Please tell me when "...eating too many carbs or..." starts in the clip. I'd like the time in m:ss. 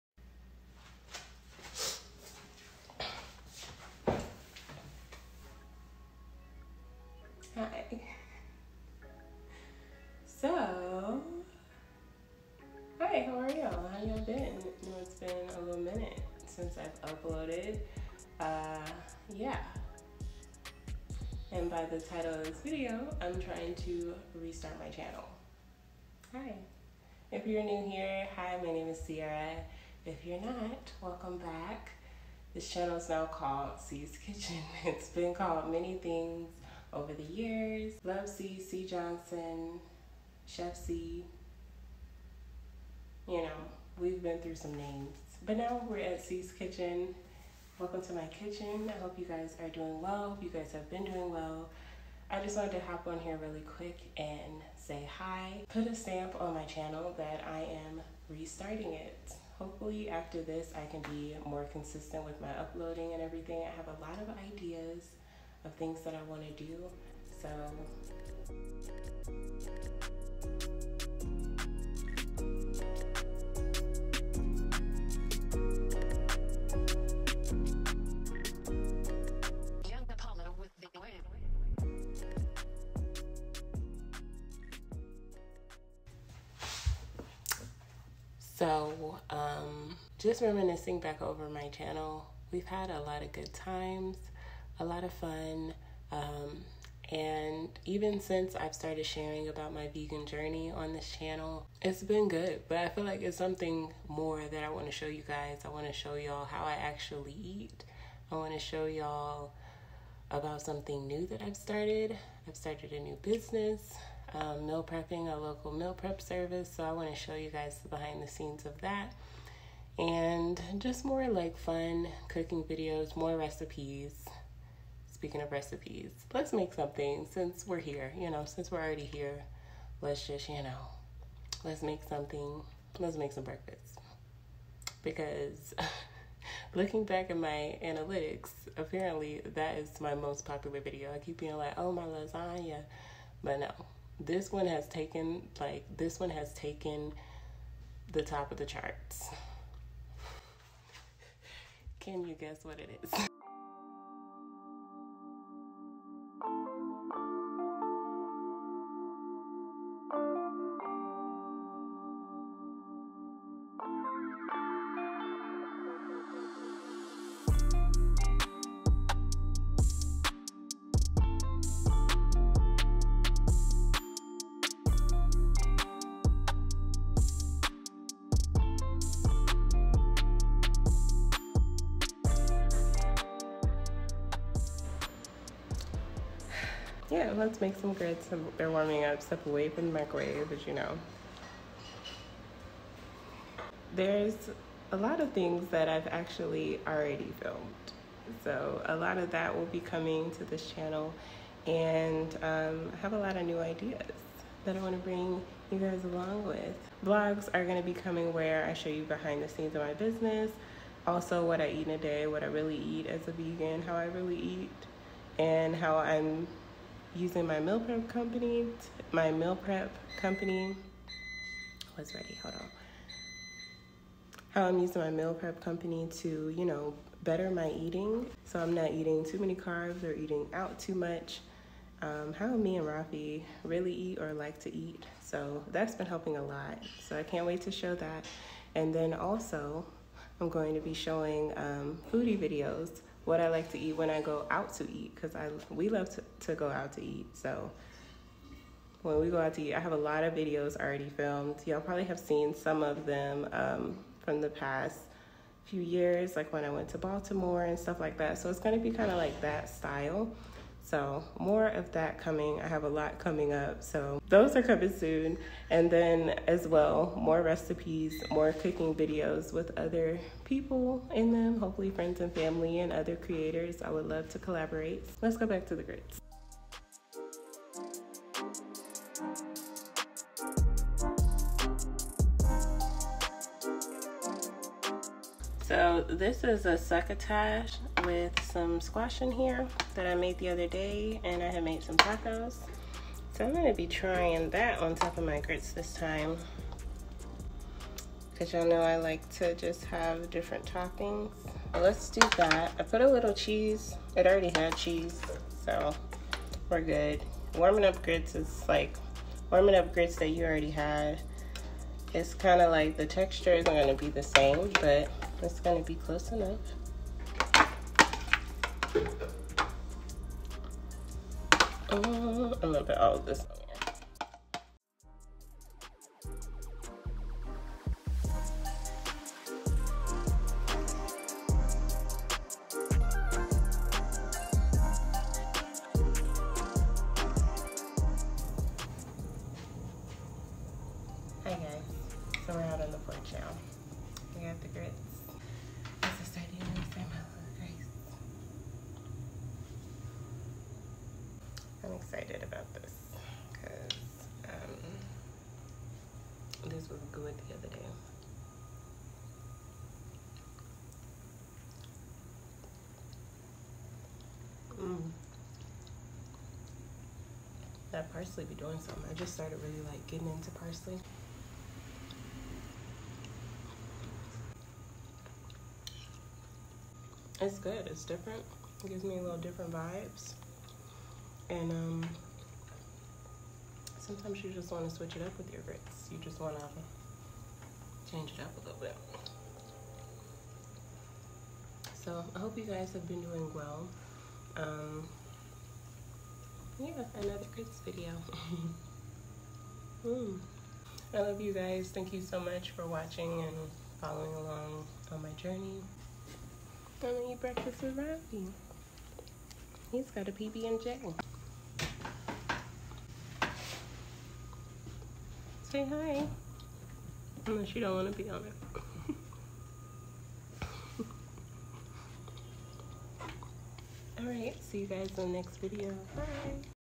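3:48.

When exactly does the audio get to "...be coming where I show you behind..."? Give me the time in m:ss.
3:27.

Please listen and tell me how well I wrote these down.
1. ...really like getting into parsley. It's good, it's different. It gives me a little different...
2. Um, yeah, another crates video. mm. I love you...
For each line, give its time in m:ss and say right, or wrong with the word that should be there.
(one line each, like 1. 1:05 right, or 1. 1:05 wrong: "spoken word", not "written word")
1. 6:09 right
2. 6:34 right.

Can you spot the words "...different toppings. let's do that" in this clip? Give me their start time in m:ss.
5:00.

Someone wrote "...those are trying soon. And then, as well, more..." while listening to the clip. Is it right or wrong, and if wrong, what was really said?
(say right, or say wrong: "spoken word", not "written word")
wrong: "coming", not "trying".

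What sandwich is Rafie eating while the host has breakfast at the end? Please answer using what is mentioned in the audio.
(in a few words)
PB and J.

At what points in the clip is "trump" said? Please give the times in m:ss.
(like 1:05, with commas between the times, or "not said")
not said.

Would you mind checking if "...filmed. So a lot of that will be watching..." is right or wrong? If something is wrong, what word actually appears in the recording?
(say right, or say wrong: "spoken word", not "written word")
wrong: "coming", not "watching".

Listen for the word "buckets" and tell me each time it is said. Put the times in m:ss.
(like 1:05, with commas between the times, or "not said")
not said.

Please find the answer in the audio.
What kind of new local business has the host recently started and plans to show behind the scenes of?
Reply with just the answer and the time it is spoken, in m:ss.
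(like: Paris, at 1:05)
meal prep service, at 1:55.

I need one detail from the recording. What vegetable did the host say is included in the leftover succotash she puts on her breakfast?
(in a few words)
squash.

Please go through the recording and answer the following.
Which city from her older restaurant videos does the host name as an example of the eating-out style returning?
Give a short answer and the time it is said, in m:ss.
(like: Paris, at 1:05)
Baltimore, at 4:16.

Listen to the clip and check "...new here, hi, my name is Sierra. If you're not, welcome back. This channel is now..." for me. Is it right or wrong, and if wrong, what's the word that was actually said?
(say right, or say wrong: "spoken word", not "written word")
right.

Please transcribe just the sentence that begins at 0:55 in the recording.
Put a stamp on my channel that I am restarting it.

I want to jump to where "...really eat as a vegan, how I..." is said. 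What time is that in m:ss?
3:32.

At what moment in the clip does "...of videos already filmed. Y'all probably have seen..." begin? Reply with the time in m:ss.
4:10.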